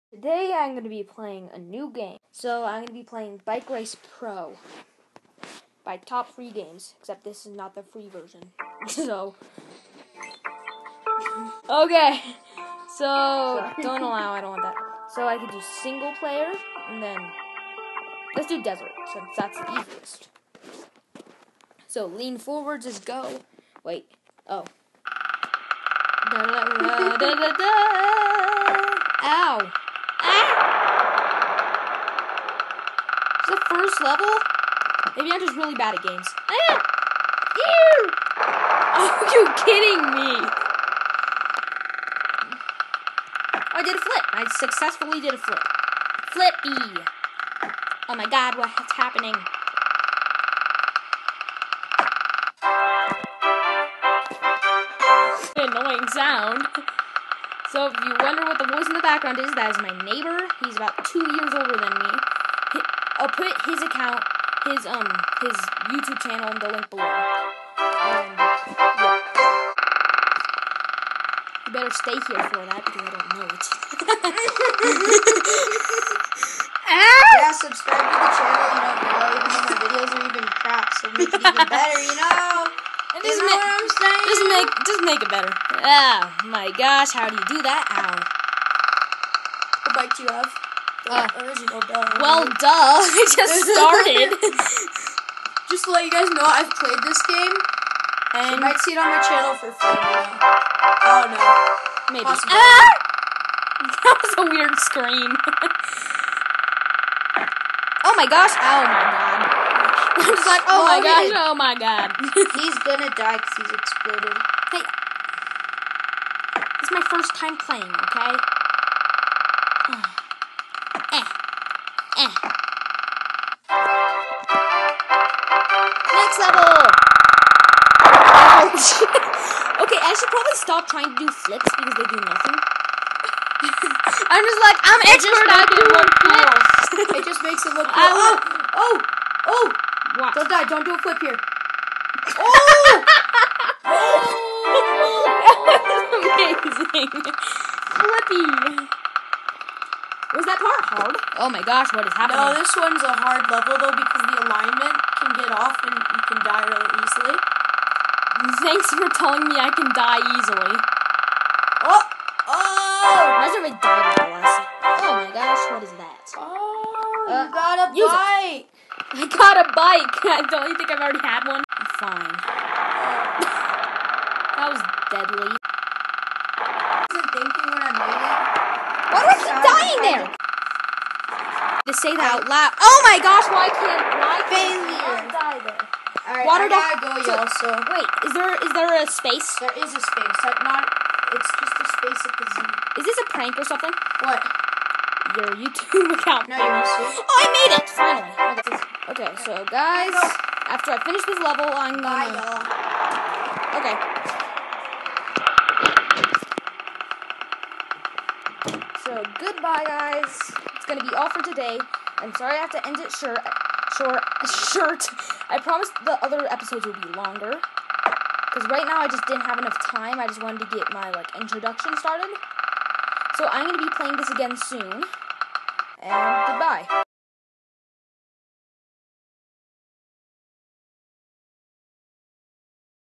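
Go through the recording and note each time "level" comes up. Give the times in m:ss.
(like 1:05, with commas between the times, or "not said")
0:34, 2:06, 2:33, 3:21.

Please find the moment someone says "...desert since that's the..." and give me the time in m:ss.
0:18.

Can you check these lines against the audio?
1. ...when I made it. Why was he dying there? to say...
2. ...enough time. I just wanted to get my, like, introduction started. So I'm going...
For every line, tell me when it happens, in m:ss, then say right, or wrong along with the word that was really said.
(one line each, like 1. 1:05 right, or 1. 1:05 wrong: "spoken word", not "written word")
1. 2:57 right
2. 3:39 right.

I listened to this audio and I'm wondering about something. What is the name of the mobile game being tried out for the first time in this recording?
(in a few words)
Bike Race Pro.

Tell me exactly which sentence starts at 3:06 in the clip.
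Right, Water I gotta go, so, y'all.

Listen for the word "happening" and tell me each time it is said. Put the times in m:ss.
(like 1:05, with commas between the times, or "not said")
0:48, 2:32.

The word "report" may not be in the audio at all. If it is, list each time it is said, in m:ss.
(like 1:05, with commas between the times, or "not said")
not said.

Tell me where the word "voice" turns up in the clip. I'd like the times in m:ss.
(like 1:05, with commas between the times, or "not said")
0:58.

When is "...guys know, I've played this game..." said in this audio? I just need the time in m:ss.
1:36.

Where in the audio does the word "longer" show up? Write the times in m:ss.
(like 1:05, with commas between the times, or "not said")
3:37.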